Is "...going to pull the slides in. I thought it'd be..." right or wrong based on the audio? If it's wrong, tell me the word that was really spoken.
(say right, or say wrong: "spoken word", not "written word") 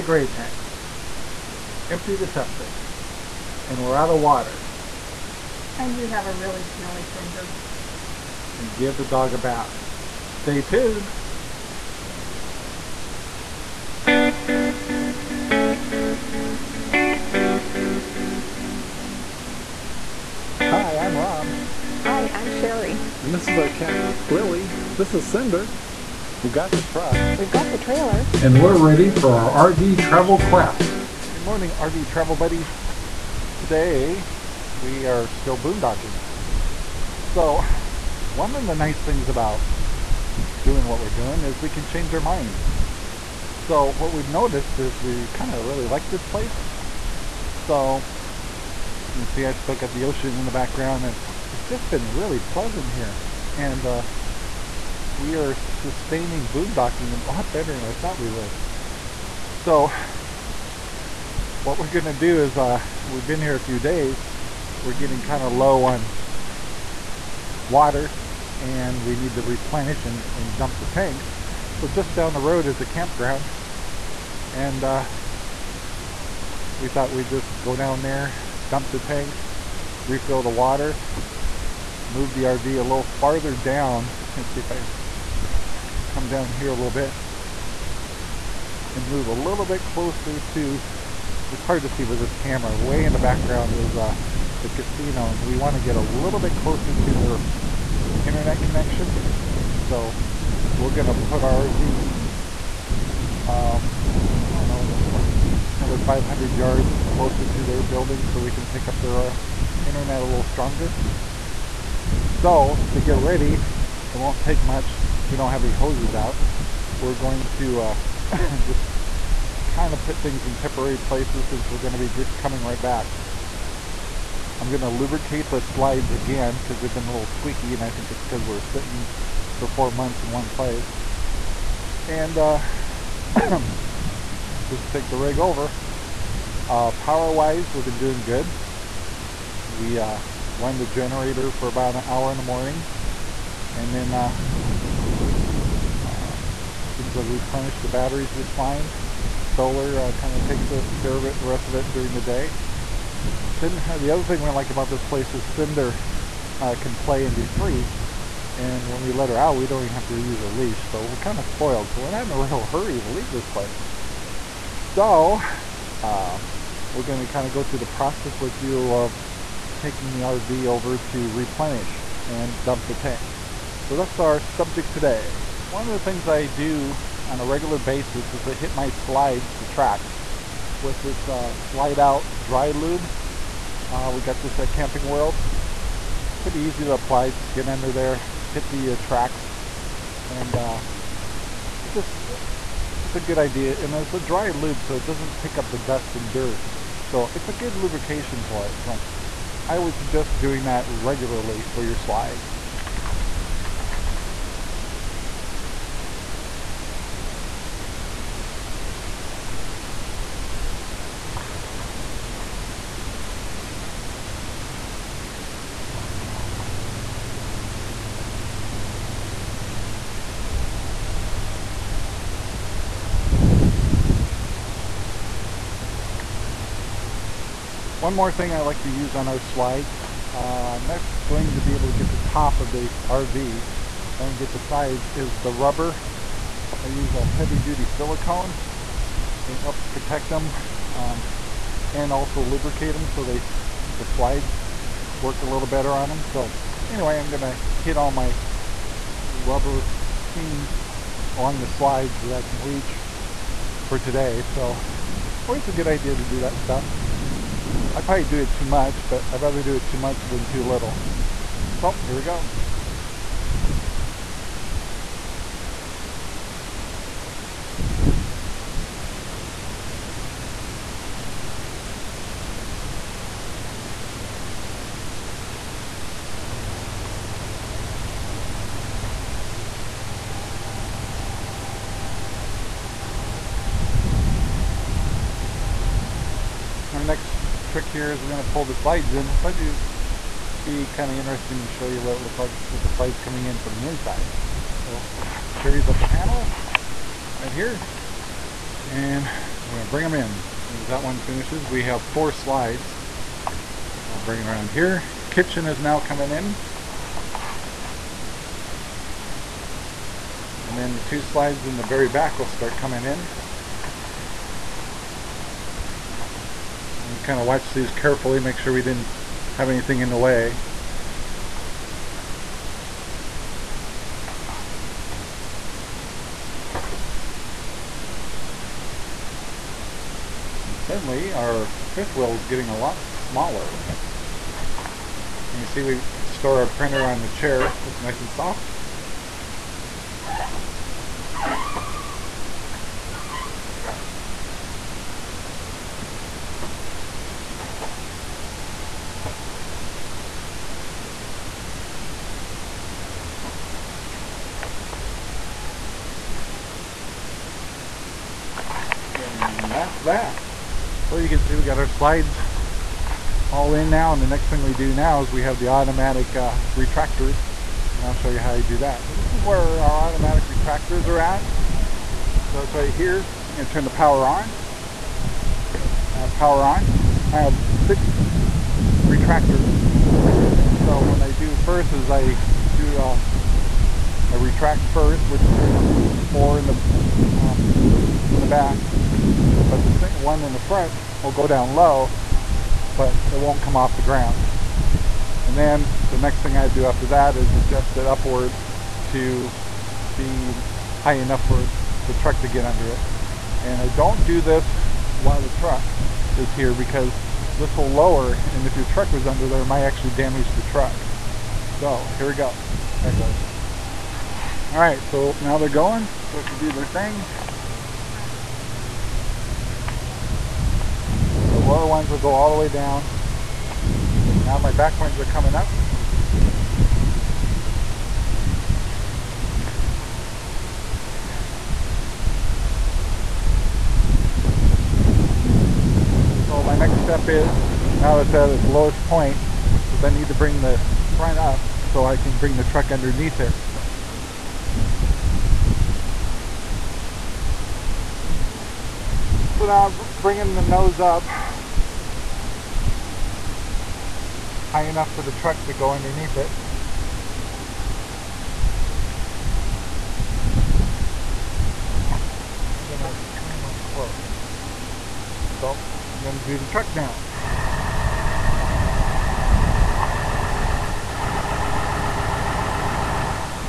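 right.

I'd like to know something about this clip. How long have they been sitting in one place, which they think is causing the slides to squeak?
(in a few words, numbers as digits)
4 months.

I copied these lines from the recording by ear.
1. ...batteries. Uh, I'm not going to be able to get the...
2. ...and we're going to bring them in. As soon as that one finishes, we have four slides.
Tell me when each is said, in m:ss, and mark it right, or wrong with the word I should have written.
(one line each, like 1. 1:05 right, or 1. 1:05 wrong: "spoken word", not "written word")
1. 3:49 wrong: "slides", not "batteries"
2. 4:58 right.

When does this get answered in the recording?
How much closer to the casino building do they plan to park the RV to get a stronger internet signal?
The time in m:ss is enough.
1:46.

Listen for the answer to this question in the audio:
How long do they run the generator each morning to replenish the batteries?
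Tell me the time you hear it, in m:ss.
2:21.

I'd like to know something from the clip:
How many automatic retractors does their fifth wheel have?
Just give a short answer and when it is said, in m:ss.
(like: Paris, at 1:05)
6, at 6:17.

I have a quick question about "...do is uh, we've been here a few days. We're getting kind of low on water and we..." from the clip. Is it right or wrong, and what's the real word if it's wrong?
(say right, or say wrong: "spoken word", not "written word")
right.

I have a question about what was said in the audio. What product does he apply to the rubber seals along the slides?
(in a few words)
Heavy duty silicone.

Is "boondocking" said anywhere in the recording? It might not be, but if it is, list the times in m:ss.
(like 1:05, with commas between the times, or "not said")
0:35, 0:56.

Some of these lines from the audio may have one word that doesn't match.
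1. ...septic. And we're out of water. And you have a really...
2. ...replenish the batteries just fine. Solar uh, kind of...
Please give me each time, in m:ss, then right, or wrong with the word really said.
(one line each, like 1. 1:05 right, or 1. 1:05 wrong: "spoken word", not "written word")
1. 0:02 right
2. 2:27 right.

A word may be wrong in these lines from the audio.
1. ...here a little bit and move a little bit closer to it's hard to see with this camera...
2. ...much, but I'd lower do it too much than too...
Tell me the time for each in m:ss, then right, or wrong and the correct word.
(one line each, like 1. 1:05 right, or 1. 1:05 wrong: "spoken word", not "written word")
1. 1:26 right
2. 4:18 wrong: "rather", not "lower".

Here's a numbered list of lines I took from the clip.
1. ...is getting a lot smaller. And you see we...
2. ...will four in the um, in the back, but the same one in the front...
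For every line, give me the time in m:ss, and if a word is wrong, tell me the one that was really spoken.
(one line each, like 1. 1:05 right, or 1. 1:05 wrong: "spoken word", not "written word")
1. 5:32 right
2. 6:25 right.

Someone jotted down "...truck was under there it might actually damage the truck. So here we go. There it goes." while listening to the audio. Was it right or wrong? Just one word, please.
right.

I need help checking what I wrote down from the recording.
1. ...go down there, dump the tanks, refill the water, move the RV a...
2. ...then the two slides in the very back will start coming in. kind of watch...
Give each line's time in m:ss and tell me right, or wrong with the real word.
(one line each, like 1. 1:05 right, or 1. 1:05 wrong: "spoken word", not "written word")
1. 1:17 right
2. 5:10 right.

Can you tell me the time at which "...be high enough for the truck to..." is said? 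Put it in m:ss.
6:40.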